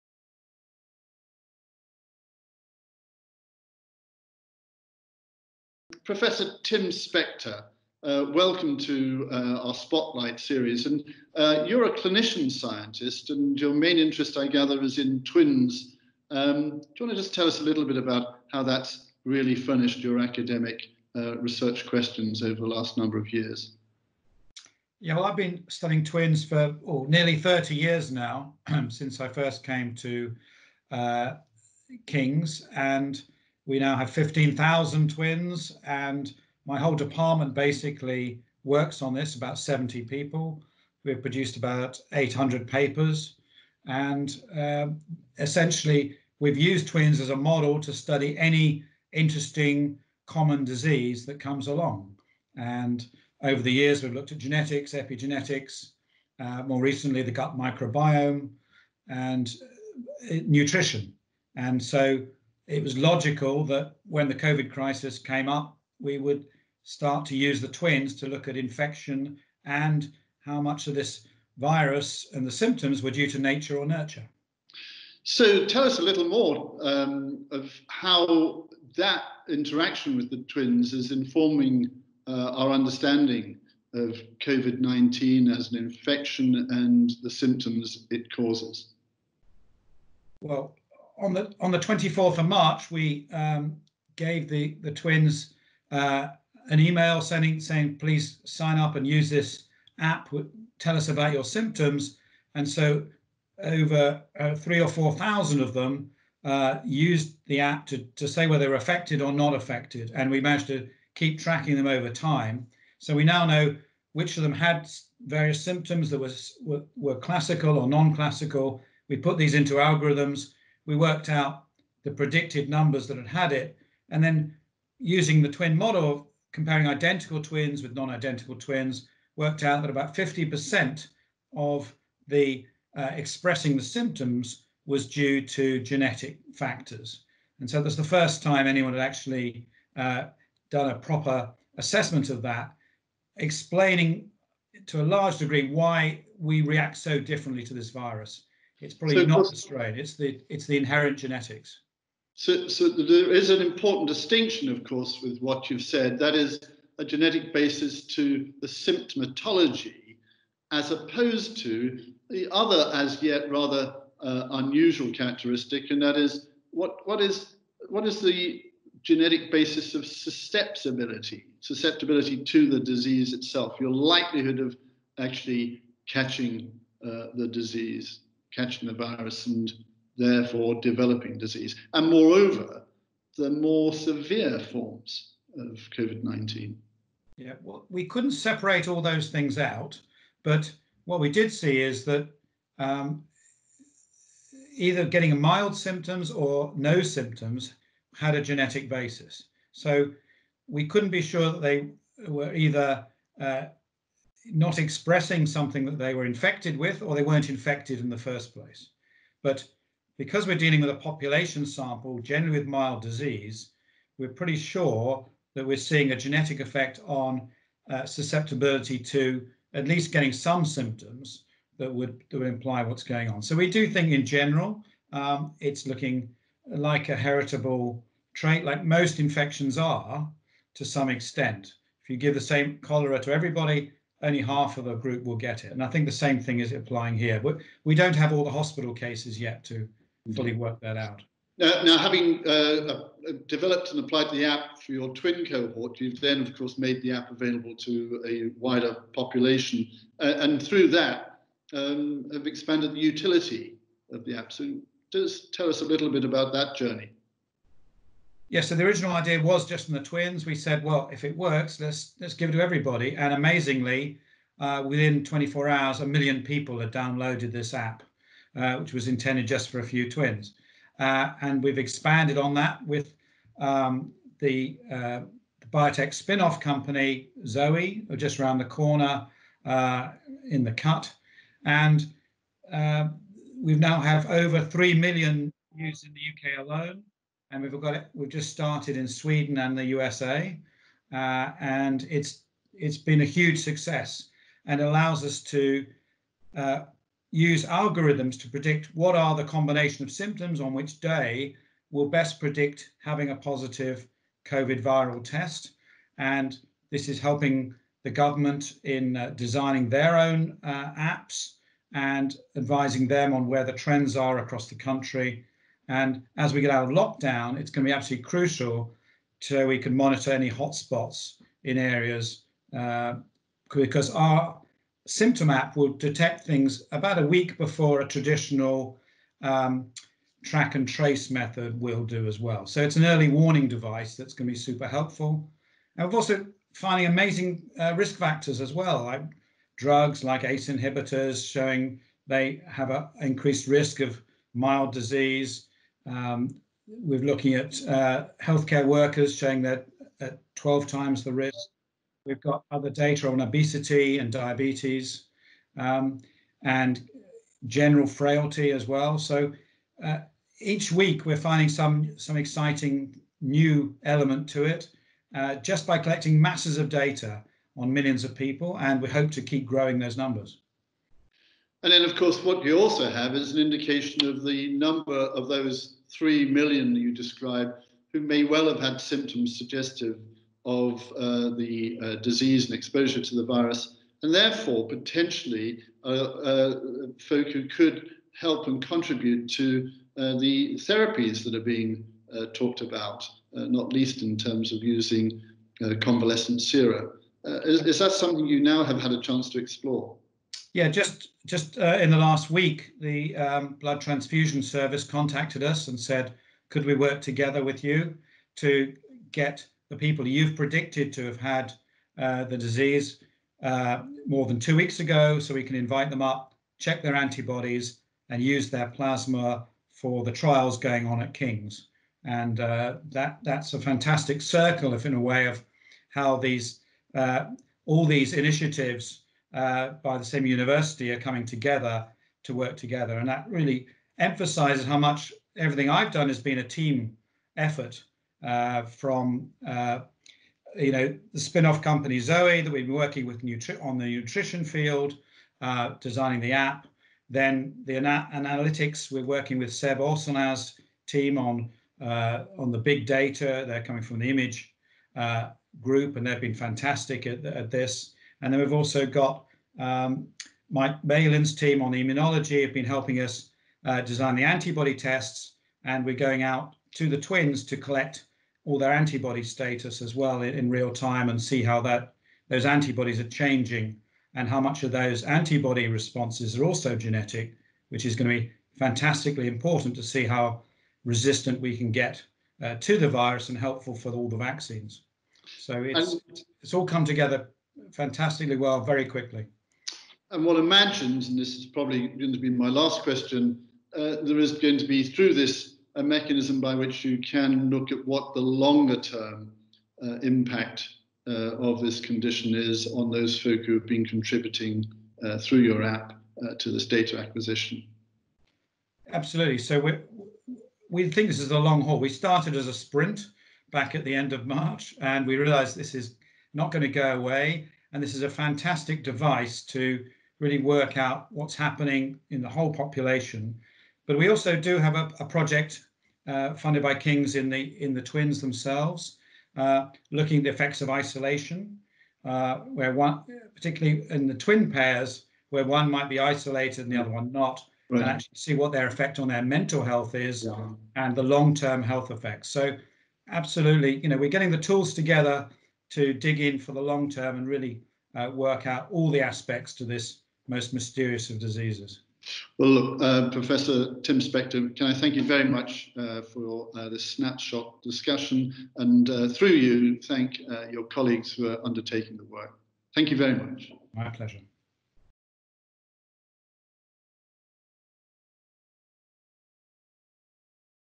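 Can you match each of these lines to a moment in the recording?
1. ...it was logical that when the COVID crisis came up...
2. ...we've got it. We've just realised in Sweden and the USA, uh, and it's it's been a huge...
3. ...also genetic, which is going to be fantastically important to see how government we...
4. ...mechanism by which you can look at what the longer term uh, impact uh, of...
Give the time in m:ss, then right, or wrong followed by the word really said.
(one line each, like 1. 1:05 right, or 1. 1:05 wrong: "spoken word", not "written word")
1. 1:02 right
2. 4:47 wrong: "started", not "realised"
3. 7:56 wrong: "resistant", not "government"
4. 8:16 right.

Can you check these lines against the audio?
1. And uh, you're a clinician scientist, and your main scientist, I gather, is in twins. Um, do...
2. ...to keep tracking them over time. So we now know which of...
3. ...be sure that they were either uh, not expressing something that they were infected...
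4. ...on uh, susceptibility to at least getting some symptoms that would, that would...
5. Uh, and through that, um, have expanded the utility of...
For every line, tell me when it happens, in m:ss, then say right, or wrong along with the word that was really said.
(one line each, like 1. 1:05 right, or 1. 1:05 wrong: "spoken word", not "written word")
1. 0:10 wrong: "interest", not "scientist"
2. 1:50 right
3. 3:21 right
4. 3:37 right
5. 4:10 right.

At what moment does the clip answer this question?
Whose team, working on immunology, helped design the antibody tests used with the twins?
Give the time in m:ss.
7:40.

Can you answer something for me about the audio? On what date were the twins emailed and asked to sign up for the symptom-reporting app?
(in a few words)
24th of March.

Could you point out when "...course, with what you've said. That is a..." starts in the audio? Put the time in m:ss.
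2:34.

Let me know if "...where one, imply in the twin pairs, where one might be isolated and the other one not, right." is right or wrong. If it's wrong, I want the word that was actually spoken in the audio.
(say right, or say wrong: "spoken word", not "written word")
wrong: "particularly", not "imply".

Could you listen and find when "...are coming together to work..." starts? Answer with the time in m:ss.
7:11.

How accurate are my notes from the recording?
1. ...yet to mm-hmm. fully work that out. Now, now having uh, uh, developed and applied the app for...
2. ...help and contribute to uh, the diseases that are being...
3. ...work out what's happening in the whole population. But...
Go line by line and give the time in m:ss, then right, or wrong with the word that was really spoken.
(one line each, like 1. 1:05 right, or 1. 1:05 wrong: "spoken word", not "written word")
1. 3:59 right
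2. 6:28 wrong: "therapies", not "diseases"
3. 8:40 right.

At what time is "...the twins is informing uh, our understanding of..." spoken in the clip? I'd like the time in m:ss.
1:20.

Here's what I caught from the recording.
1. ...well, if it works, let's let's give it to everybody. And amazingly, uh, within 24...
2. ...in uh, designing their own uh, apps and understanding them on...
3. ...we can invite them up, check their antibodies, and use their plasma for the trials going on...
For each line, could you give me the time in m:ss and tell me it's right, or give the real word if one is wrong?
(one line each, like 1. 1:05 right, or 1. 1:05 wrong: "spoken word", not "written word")
1. 4:20 right
2. 5:08 wrong: "advising", not "understanding"
3. 6:55 right.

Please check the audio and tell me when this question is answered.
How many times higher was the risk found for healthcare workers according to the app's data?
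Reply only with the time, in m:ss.
5:50.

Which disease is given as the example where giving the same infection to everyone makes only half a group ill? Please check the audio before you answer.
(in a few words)
cholera.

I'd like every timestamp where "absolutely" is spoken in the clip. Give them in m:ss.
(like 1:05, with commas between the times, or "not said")
5:17, 8:29, 9:03.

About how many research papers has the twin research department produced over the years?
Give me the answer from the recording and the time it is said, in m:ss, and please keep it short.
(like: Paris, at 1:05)
800, at 0:41.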